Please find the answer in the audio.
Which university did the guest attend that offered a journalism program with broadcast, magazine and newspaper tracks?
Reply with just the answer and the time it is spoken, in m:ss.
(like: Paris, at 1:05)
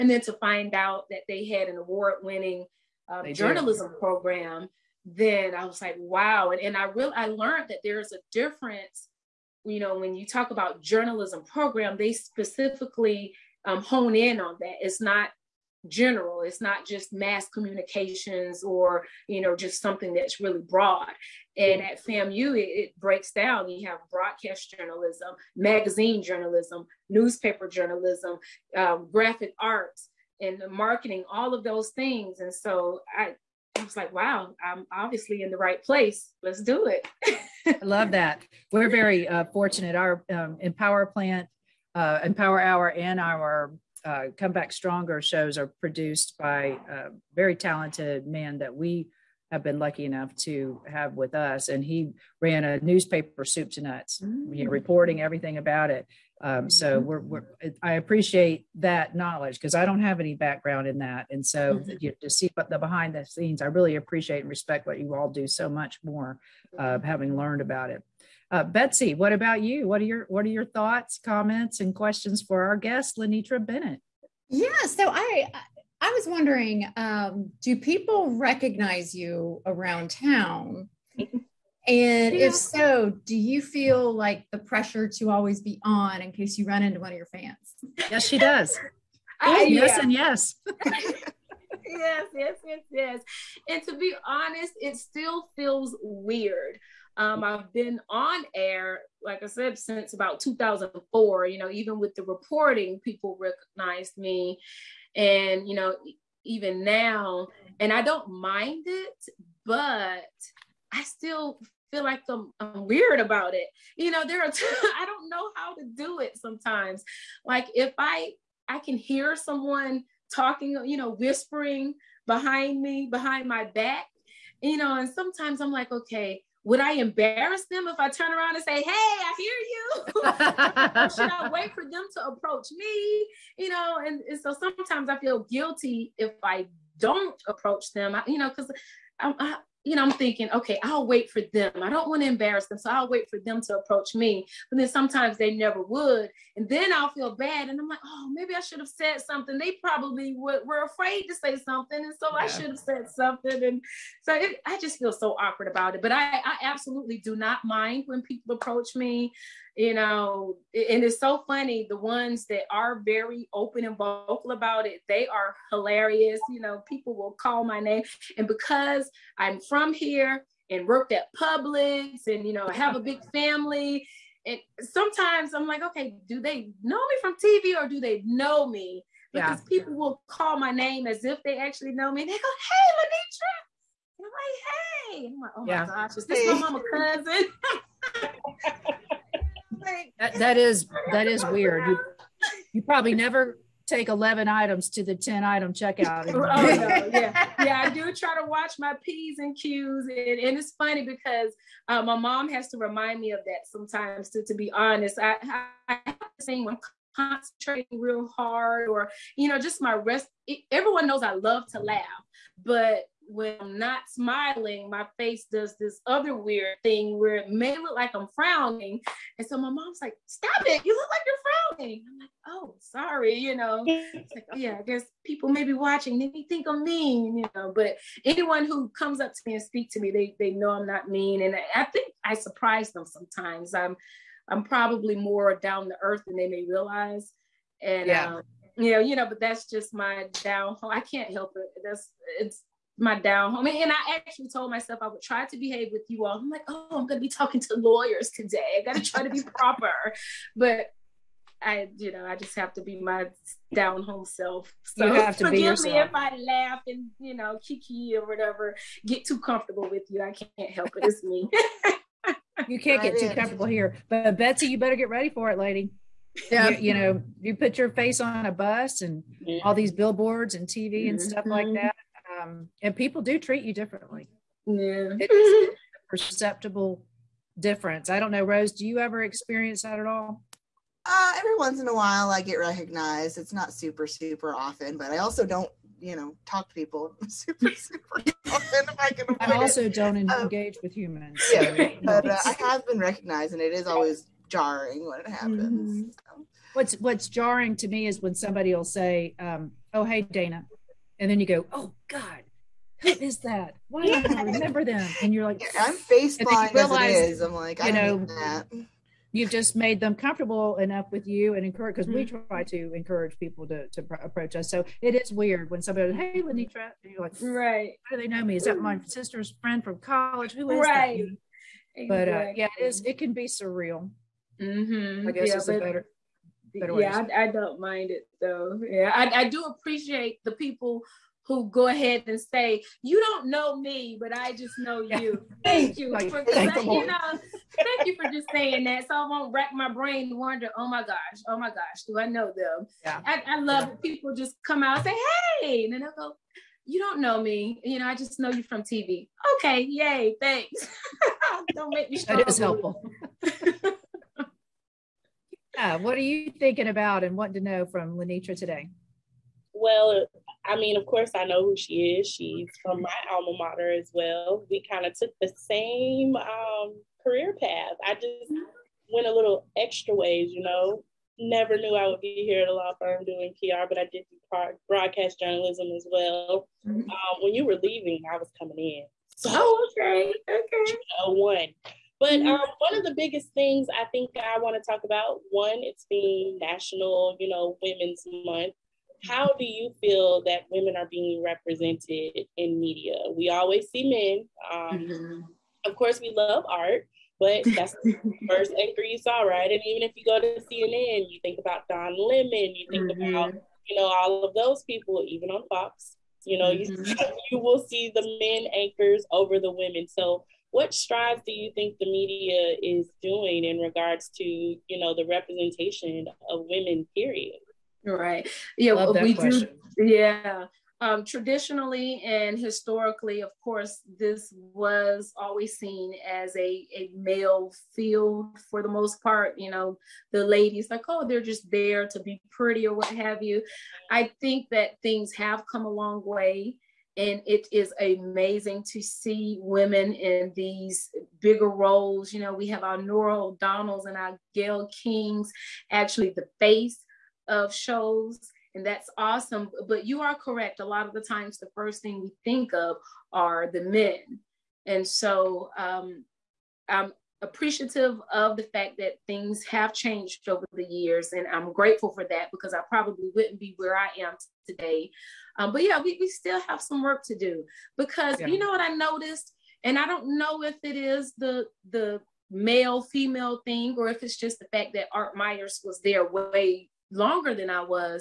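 FAMU, at 0:22.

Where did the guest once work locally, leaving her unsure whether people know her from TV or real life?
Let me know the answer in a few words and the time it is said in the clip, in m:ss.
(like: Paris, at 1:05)
Publix, at 2:51.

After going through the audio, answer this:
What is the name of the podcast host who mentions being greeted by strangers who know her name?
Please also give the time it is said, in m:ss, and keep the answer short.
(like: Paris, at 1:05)
Dana, at 5:00.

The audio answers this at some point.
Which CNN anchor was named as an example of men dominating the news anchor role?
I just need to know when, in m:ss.
6:41.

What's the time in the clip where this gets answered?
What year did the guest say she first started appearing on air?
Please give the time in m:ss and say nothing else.
1:40.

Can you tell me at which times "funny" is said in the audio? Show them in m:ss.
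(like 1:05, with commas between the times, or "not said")
2:41, 3:20.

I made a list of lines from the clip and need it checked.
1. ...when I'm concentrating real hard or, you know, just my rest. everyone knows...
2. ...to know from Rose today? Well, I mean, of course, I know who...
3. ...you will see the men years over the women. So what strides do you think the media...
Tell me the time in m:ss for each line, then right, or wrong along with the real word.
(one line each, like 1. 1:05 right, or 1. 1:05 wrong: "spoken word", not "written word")
1. 3:26 right
2. 5:57 wrong: "Lanetra", not "Rose"
3. 6:47 wrong: "anchors", not "years".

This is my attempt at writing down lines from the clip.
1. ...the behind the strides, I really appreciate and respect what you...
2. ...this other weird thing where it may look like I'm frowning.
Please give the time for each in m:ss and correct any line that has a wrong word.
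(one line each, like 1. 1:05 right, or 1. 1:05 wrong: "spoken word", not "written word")
1. 1:02 wrong: "scenes", not "strides"
2. 3:35 right.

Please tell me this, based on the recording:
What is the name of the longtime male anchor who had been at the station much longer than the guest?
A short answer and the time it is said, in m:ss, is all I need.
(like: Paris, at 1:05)
Art Myers, at 7:55.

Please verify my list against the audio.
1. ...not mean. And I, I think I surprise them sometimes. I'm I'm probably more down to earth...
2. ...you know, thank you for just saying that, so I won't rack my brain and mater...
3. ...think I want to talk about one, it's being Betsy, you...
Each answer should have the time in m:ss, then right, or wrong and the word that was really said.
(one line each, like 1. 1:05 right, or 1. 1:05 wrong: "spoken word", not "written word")
1. 3:50 right
2. 5:36 wrong: "wonder", not "mater"
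3. 6:24 wrong: "National", not "Betsy".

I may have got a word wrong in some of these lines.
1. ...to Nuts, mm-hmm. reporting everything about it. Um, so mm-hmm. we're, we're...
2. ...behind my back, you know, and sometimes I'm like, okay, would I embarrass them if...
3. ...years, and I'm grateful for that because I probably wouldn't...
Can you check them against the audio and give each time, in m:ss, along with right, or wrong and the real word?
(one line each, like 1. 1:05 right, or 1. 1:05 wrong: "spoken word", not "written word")
1. 0:53 right
2. 2:03 right
3. 7:40 right.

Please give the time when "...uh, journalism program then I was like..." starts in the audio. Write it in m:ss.
0:03.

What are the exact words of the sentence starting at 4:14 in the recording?
So forgive me if I laugh and, you know, kiki or whatever, get too comfortable with you.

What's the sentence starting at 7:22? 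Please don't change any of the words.
You know, we have our Norah O'Donnells and our Gail Kings, actually the face of shows, and that's awesome.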